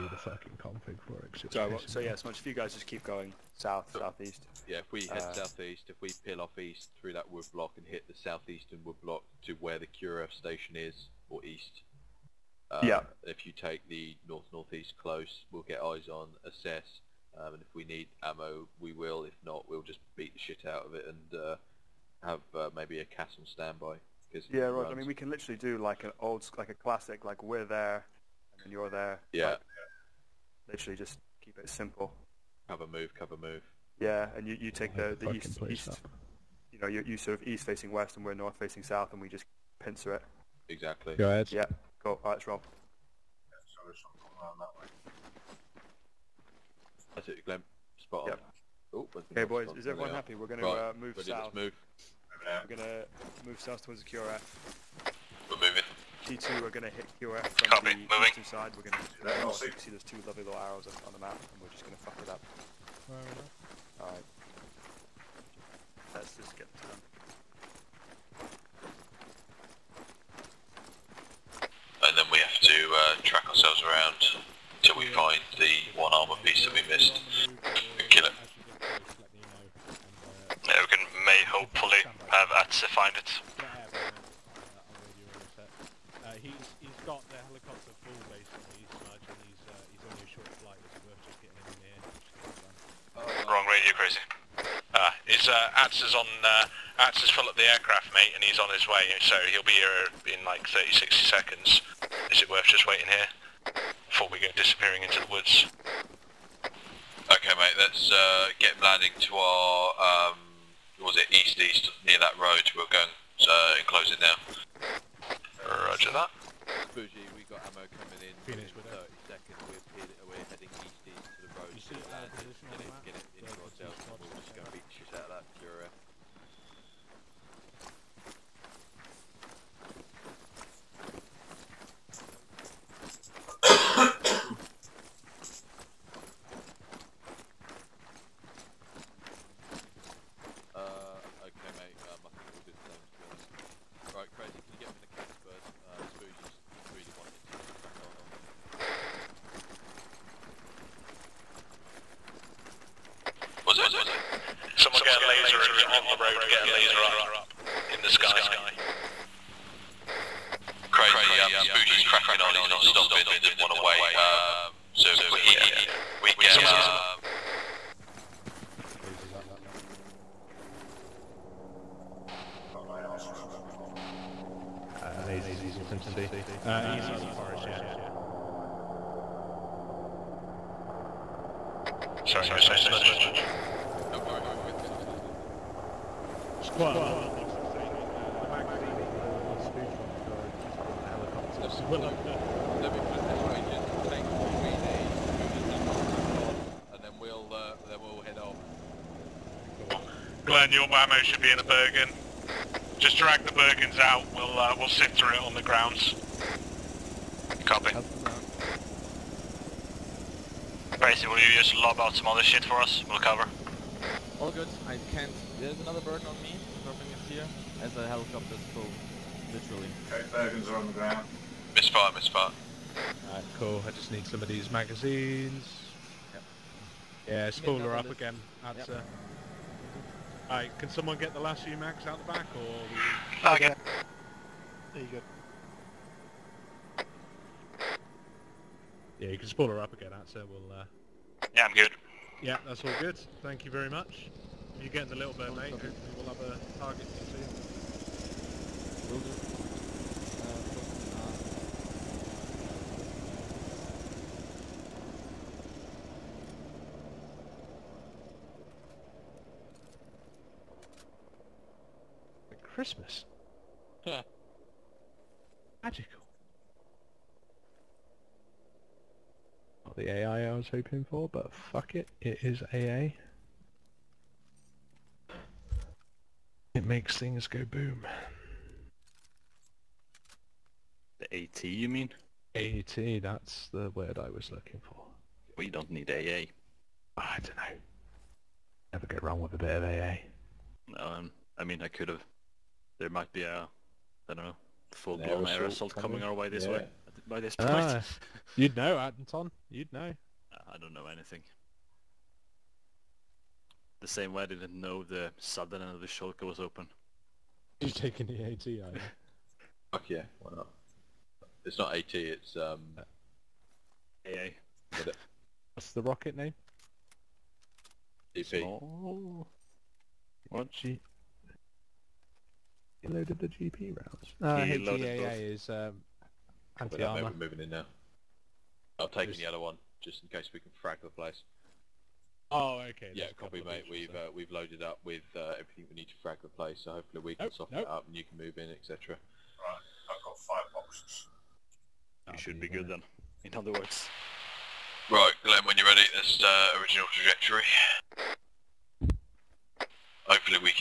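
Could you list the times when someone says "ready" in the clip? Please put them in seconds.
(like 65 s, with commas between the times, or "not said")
51 s, 345 s.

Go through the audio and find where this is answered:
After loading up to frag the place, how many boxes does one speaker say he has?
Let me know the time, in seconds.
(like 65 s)
340 s.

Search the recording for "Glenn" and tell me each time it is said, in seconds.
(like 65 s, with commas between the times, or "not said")
47 s, 200 s, 345 s.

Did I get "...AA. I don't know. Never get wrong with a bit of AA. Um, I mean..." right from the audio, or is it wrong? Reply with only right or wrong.
right.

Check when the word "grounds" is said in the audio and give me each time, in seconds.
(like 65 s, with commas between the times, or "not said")
205 s, 220 s.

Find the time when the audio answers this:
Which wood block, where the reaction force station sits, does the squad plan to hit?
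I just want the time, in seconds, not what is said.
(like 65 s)
8 s.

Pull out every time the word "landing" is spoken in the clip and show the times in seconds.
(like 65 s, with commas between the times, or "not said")
108 s.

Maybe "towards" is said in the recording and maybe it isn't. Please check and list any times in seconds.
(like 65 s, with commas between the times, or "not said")
53 s.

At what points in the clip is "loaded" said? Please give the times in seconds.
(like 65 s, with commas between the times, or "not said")
323 s, 334 s.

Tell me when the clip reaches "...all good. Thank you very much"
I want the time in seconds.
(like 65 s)
242 s.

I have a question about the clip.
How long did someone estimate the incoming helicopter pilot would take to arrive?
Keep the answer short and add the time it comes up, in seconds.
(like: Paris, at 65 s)
30, 60 seconds, at 100 s.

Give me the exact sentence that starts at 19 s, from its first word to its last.
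If not, we'll just beat the shit out of it and uh, have uh, maybe a castle standby yeah, right.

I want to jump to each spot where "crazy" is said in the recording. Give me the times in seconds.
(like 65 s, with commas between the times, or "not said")
93 s, 160 s.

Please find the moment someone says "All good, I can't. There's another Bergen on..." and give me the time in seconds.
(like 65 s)
214 s.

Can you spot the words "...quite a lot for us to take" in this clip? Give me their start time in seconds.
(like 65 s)
186 s.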